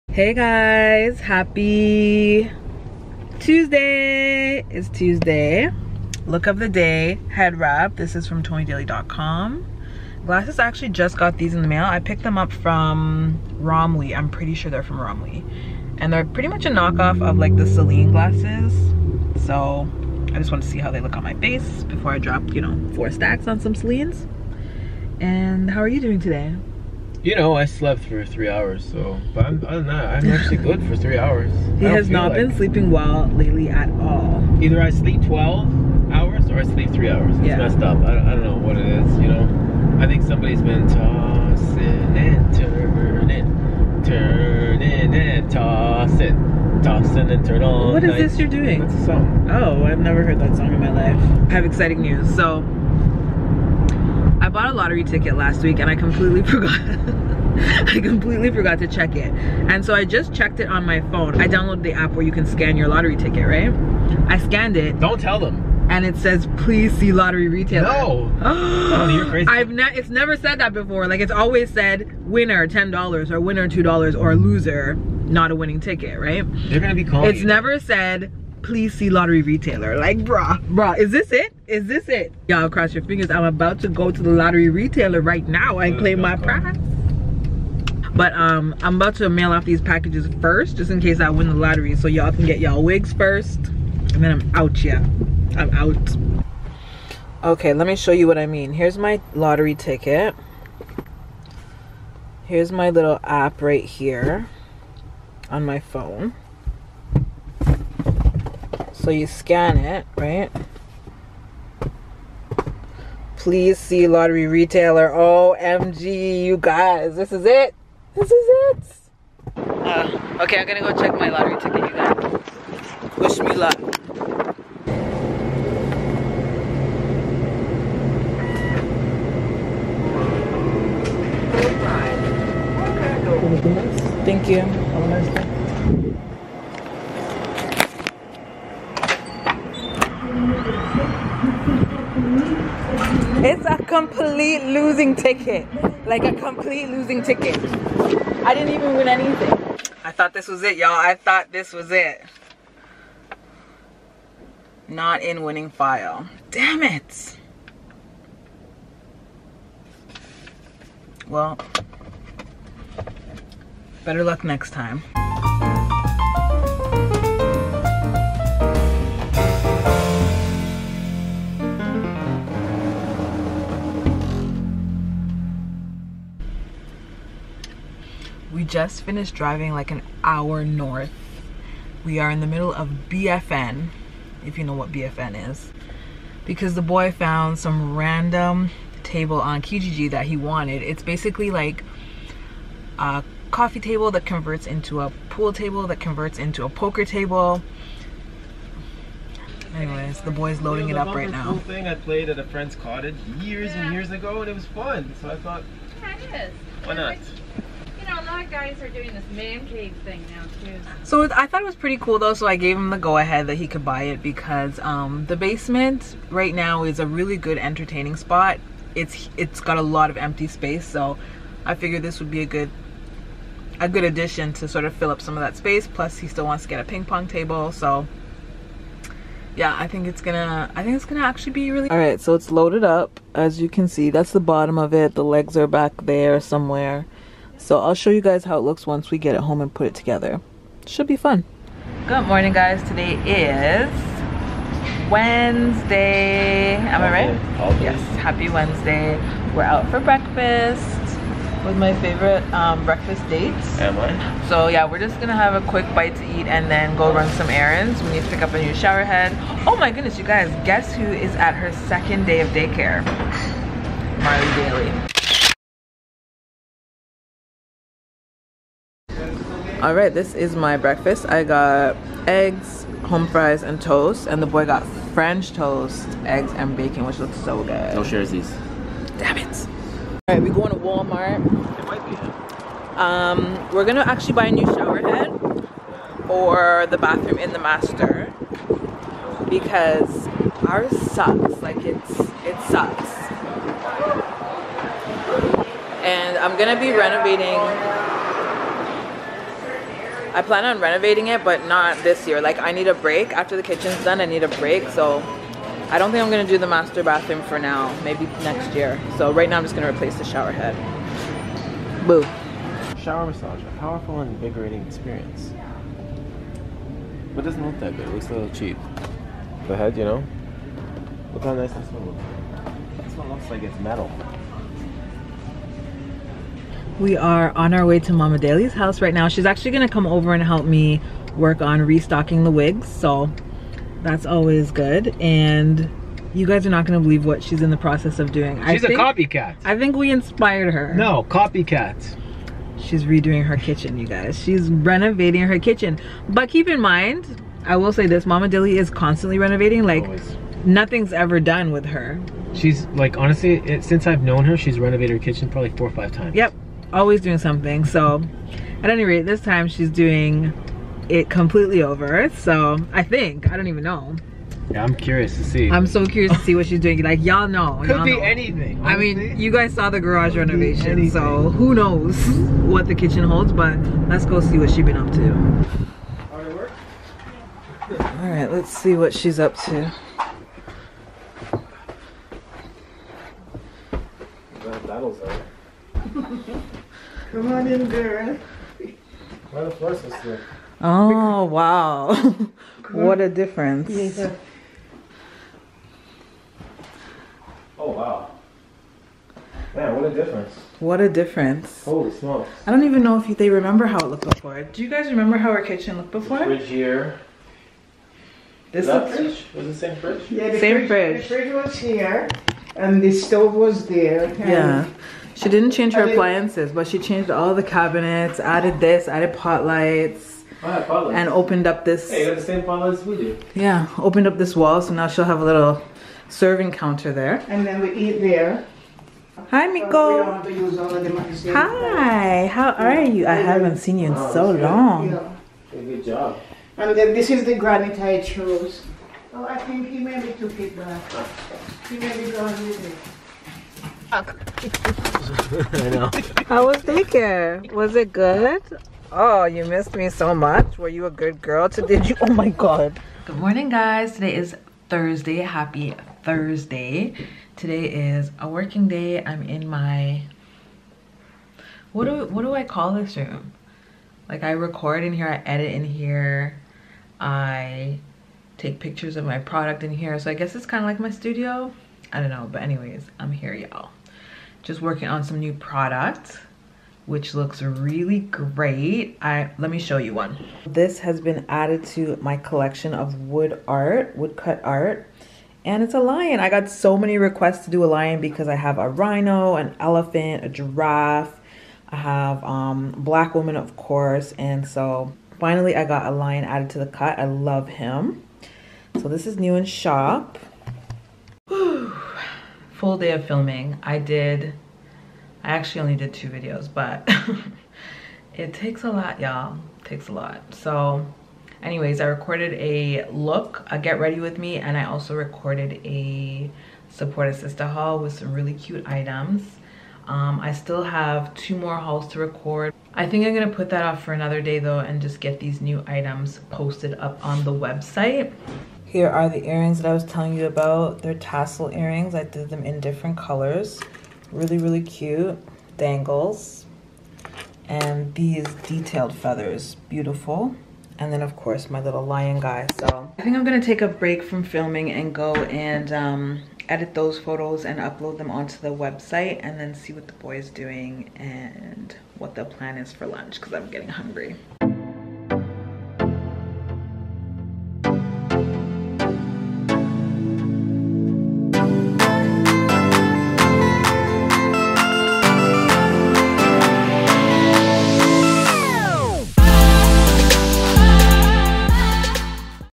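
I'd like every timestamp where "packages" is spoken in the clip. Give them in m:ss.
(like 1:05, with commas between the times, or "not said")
1:29.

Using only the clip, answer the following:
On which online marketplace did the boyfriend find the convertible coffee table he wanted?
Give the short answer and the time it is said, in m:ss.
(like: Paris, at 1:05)
Kijiji, at 3:09.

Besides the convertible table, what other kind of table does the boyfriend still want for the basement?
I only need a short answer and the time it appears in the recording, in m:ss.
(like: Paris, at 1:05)
Ping pong table, at 3:46.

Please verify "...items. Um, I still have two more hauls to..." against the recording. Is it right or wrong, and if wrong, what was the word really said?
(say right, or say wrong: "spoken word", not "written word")
right.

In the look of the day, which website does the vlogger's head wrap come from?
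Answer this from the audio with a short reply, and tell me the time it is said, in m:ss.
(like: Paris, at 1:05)
tonidaley.com, at 0:08.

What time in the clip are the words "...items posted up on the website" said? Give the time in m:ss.
8:45.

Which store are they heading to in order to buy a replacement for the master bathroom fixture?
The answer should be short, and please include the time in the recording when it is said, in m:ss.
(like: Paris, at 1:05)
Walmart, at 4:40.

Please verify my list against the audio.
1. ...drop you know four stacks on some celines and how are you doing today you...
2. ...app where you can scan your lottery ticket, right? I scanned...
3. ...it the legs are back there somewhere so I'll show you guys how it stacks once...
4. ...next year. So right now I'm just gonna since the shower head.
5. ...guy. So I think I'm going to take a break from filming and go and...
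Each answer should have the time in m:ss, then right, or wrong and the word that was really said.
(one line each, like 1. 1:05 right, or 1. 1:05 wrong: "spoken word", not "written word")
1. 0:22 right
2. 1:01 right
3. 3:54 wrong: "looks", not "stacks"
4. 5:08 wrong: "replace", not "since"
5. 9:02 right.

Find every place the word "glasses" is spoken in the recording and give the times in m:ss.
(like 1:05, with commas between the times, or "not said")
0:10, 0:18.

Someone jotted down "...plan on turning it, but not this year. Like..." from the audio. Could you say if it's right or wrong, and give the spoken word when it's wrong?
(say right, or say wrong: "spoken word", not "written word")
wrong: "renovating", not "turning".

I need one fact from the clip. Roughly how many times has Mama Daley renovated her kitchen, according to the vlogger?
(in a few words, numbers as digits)
4 or 5 times.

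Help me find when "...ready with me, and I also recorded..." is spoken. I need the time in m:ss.
8:33.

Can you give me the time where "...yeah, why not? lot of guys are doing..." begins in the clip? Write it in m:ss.
3:26.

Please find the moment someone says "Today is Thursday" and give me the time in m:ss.
7:34.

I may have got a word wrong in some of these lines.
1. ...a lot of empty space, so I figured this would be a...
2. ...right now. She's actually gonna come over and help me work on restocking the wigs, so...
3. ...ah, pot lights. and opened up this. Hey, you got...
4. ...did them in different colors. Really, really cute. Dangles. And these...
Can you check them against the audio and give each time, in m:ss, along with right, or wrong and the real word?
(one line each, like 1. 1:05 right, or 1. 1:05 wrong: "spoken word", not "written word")
1. 3:39 right
2. 5:29 right
3. 7:00 right
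4. 8:52 right.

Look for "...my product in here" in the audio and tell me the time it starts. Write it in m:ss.
7:49.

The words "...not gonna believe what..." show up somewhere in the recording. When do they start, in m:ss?
5:36.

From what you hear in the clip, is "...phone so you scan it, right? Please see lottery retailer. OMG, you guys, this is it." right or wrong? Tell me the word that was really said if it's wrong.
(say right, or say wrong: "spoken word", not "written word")
right.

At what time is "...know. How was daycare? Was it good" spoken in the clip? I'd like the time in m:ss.
7:25.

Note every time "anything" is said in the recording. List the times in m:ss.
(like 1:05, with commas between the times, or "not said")
2:29, 6:08.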